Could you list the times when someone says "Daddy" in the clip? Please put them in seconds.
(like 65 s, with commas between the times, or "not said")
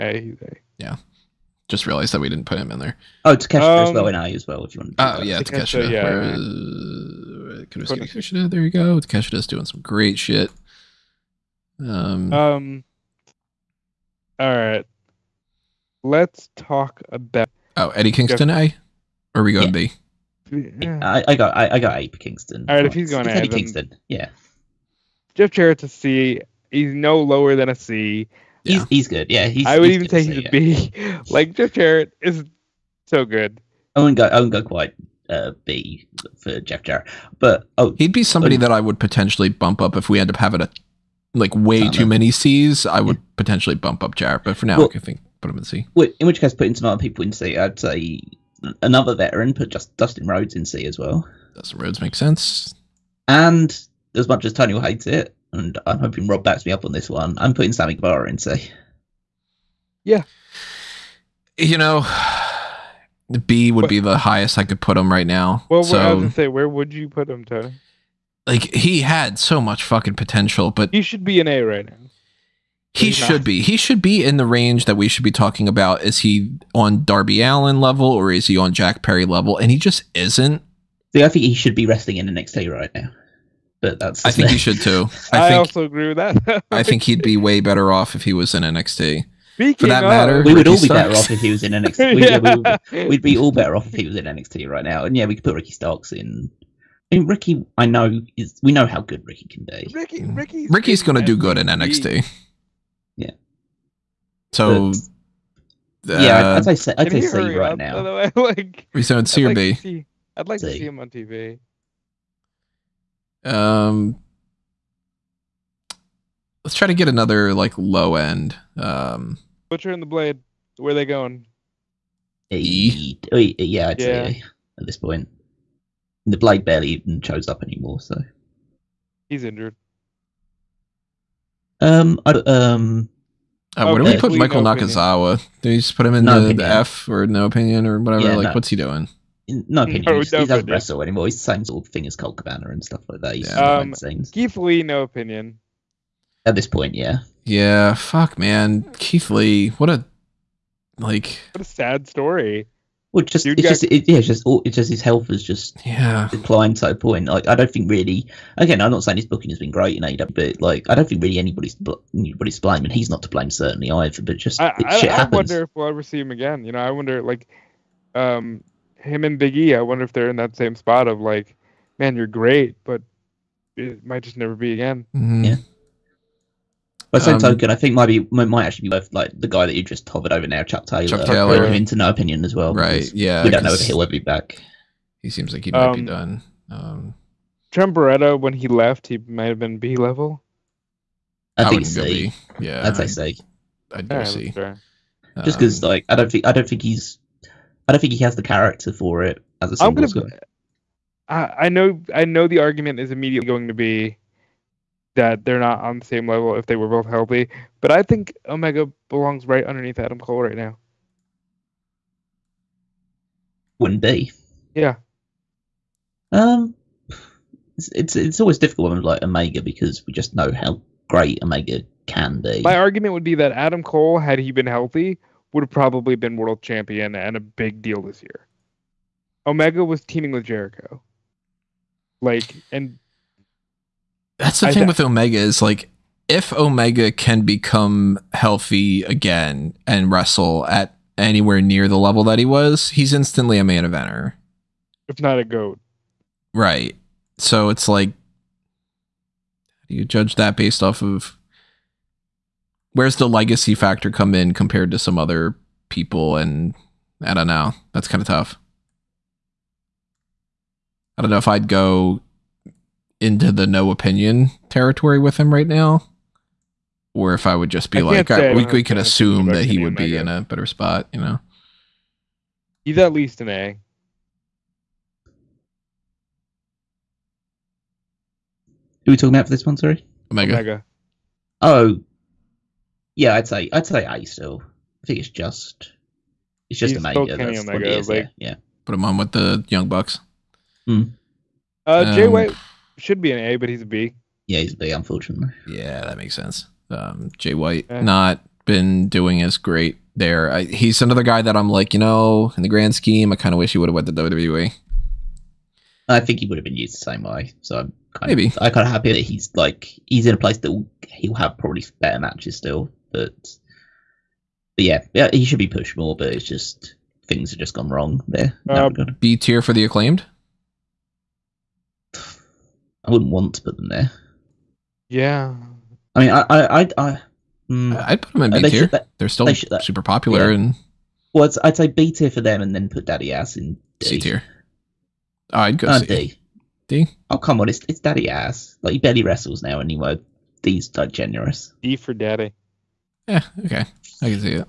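333 s, 338 s, 342 s.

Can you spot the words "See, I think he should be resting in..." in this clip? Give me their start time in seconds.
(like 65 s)
81 s.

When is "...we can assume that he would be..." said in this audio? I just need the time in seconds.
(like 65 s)
268 s.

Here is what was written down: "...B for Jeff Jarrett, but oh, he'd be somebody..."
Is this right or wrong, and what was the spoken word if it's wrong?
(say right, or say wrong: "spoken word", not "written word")
right.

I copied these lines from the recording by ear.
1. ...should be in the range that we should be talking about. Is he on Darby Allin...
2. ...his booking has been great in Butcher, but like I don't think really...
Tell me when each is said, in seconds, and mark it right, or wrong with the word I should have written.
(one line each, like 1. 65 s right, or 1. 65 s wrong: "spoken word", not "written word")
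1. 73 s right
2. 159 s wrong: "AEW", not "Butcher".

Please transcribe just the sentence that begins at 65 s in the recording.
Well, so, I was gonna say, where would you put him, Tony?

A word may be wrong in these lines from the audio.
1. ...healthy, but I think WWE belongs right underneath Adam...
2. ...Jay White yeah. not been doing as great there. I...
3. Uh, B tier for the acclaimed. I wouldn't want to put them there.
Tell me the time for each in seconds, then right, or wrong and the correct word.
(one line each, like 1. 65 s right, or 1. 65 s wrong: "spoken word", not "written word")
1. 207 s wrong: "Omega", not "WWE"
2. 297 s right
3. 318 s right.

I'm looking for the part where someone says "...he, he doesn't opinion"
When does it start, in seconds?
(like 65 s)
140 s.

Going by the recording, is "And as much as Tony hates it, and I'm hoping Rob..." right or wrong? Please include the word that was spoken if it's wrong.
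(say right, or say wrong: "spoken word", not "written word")
right.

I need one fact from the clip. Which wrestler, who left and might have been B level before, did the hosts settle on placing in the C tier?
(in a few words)
Trent Beretta.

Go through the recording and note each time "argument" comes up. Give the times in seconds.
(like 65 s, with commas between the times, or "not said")
202 s, 222 s.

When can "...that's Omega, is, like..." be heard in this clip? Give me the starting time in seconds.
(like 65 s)
287 s.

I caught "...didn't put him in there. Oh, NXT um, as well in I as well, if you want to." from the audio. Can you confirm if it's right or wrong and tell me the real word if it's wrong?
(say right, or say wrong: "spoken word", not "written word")
wrong: "Takeshita", not "NXT".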